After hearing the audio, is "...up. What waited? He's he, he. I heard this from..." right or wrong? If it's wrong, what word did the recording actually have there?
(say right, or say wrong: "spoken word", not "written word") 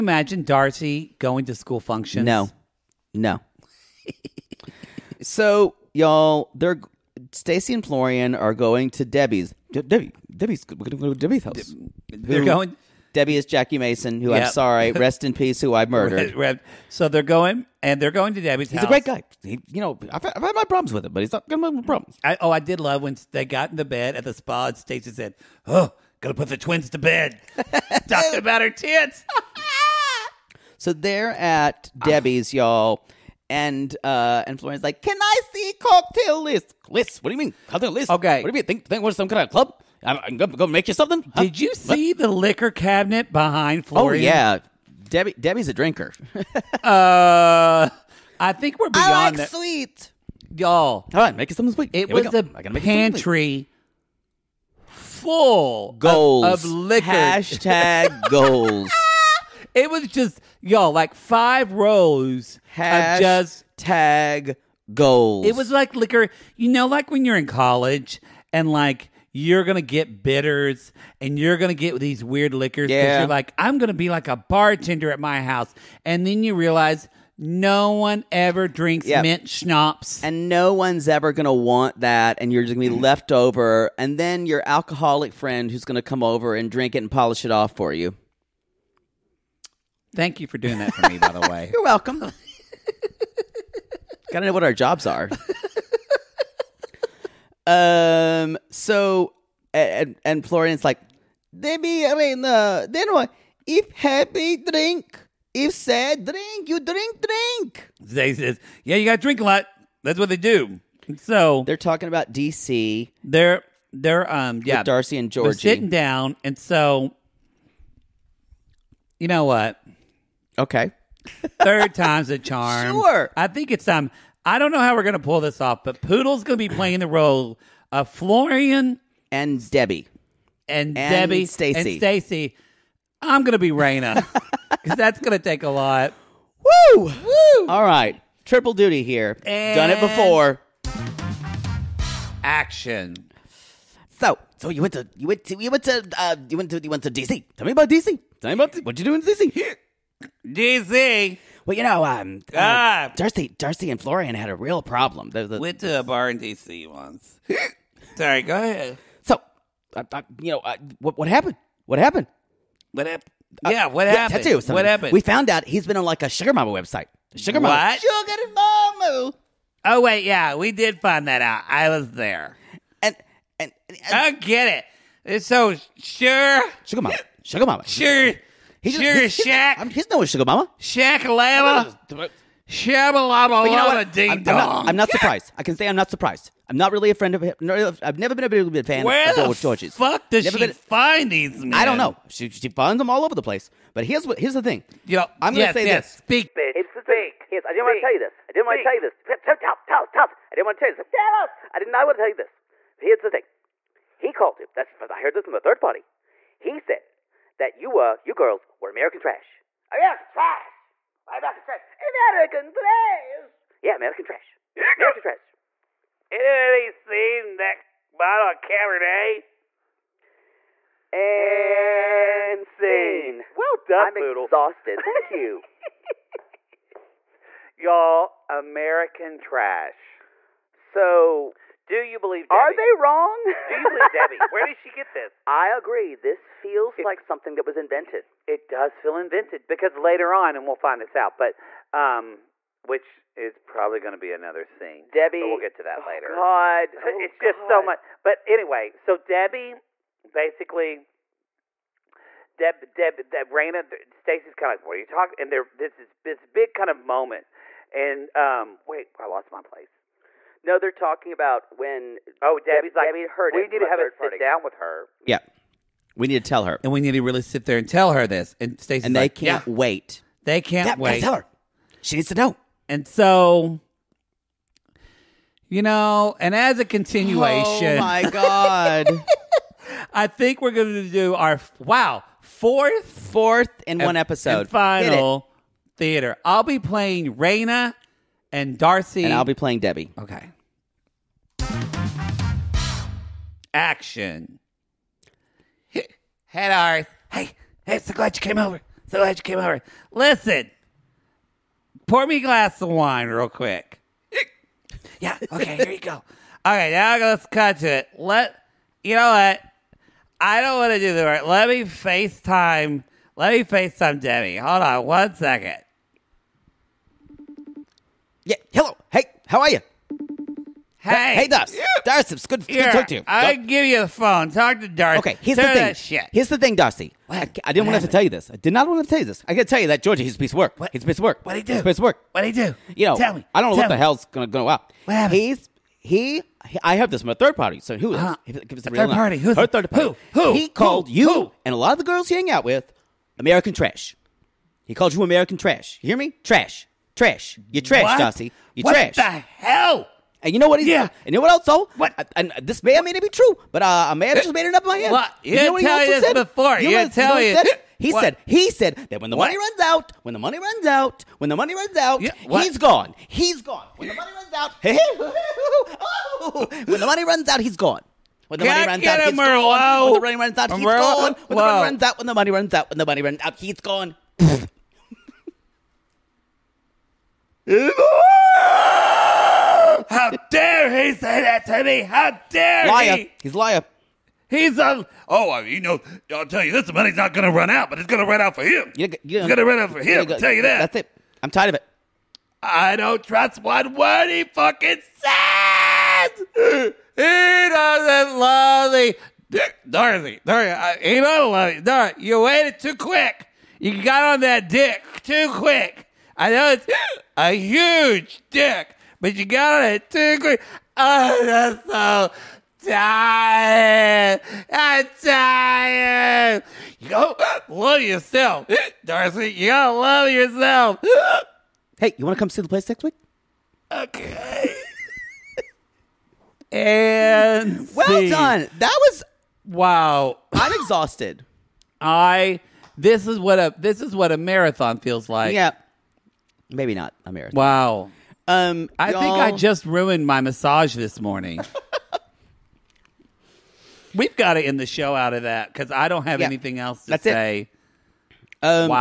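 wrong: "happened", not "waited".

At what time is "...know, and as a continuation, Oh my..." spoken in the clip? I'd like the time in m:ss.
4:35.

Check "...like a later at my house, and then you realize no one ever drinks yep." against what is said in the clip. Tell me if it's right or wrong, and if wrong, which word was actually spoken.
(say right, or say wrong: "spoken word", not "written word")
wrong: "bartender", not "later".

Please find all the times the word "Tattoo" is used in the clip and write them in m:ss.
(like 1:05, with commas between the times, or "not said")
2:44.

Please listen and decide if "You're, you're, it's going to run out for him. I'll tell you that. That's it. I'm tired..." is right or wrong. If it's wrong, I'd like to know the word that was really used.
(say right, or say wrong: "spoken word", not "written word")
right.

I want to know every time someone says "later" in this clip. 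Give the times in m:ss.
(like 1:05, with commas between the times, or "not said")
3:59, 4:06.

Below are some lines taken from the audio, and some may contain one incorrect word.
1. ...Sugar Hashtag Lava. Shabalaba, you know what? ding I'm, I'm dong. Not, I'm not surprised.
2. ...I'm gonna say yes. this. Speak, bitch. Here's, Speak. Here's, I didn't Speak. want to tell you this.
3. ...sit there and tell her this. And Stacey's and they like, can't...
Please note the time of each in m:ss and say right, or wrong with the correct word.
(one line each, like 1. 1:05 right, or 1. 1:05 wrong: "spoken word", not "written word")
1. 3:00 wrong: "Shaq", not "Hashtag"
2. 3:15 right
3. 4:27 right.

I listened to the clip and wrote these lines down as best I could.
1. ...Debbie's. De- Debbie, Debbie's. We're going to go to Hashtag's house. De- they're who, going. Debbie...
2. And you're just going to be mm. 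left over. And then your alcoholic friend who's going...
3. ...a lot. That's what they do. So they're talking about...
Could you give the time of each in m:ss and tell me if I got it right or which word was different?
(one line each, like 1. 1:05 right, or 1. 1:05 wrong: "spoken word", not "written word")
1. 0:09 wrong: "Debbie", not "Hashtag"
2. 1:22 right
3. 1:49 right.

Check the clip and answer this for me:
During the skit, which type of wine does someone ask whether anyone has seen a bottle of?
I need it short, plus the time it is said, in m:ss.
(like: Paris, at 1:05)
Cabernet, at 3:38.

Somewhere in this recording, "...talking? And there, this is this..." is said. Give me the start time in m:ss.
4:15.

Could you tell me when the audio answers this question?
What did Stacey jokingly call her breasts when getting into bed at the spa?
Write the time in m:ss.
0:26.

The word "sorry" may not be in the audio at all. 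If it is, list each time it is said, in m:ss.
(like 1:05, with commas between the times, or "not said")
0:14, 2:38.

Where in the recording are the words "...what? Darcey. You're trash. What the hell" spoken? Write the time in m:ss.
5:48.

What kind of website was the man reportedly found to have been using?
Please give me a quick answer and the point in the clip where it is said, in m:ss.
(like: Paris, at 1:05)
sugar mama website, at 2:46.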